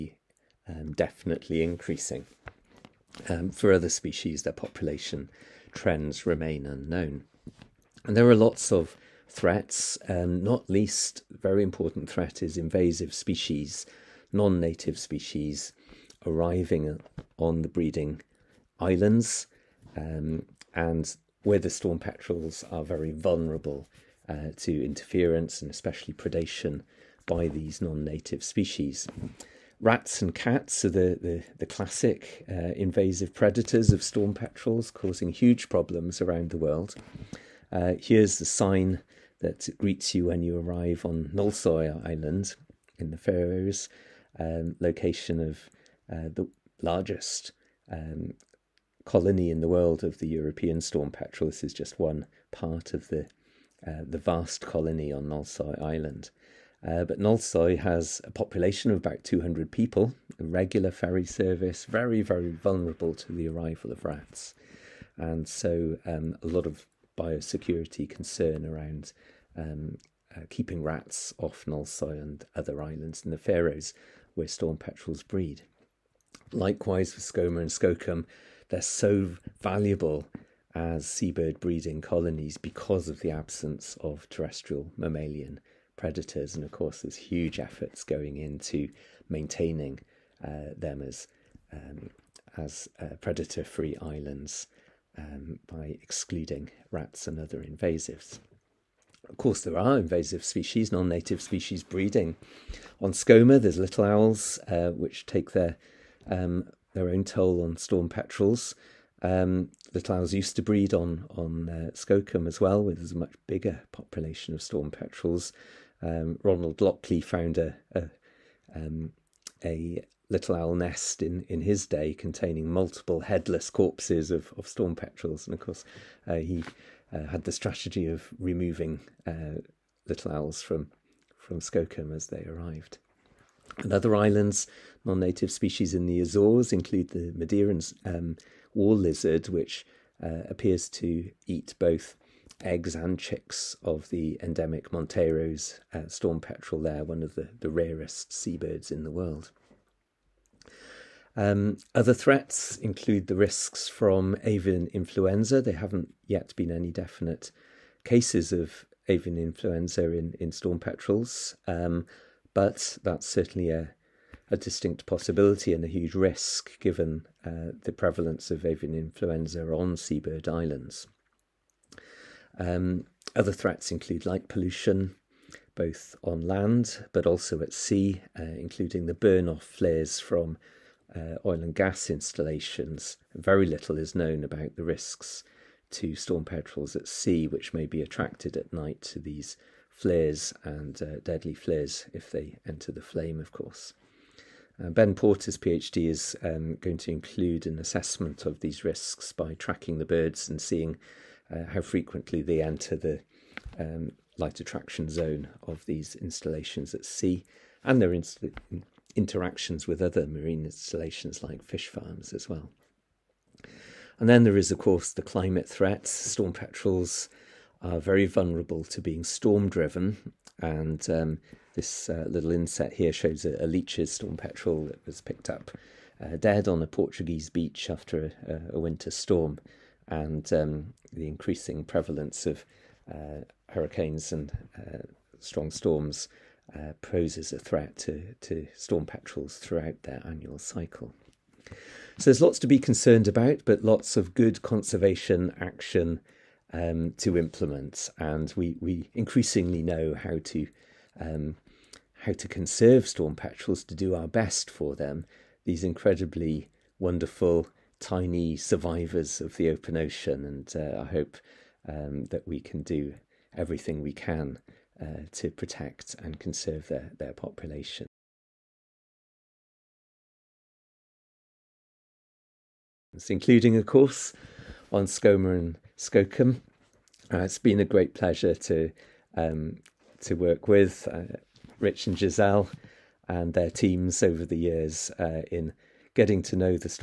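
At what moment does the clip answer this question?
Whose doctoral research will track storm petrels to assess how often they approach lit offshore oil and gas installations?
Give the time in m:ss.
3:14.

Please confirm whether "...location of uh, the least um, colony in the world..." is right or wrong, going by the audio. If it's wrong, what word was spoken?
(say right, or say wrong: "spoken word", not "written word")
wrong: "largest", not "least".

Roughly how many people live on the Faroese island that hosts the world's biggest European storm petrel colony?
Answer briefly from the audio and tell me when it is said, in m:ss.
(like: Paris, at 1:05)
200, at 0:58.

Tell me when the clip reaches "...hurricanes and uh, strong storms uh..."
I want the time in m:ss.
3:53.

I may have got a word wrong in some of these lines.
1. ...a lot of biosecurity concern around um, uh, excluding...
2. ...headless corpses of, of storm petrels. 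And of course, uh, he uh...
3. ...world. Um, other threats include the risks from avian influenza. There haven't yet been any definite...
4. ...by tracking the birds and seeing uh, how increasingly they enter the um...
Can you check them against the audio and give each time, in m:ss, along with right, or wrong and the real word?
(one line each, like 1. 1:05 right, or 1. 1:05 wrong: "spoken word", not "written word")
1. 1:06 wrong: "keeping", not "excluding"
2. 2:03 right
3. 2:29 right
4. 3:19 wrong: "frequently", not "increasingly".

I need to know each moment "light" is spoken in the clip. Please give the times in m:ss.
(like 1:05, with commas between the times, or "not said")
2:54, 3:24.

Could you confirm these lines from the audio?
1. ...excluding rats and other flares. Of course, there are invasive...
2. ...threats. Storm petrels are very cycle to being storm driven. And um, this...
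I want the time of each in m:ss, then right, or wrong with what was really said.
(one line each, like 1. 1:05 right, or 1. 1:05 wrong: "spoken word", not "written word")
1. 1:36 wrong: "invasives", not "flares"
2. 3:35 wrong: "vulnerable", not "cycle".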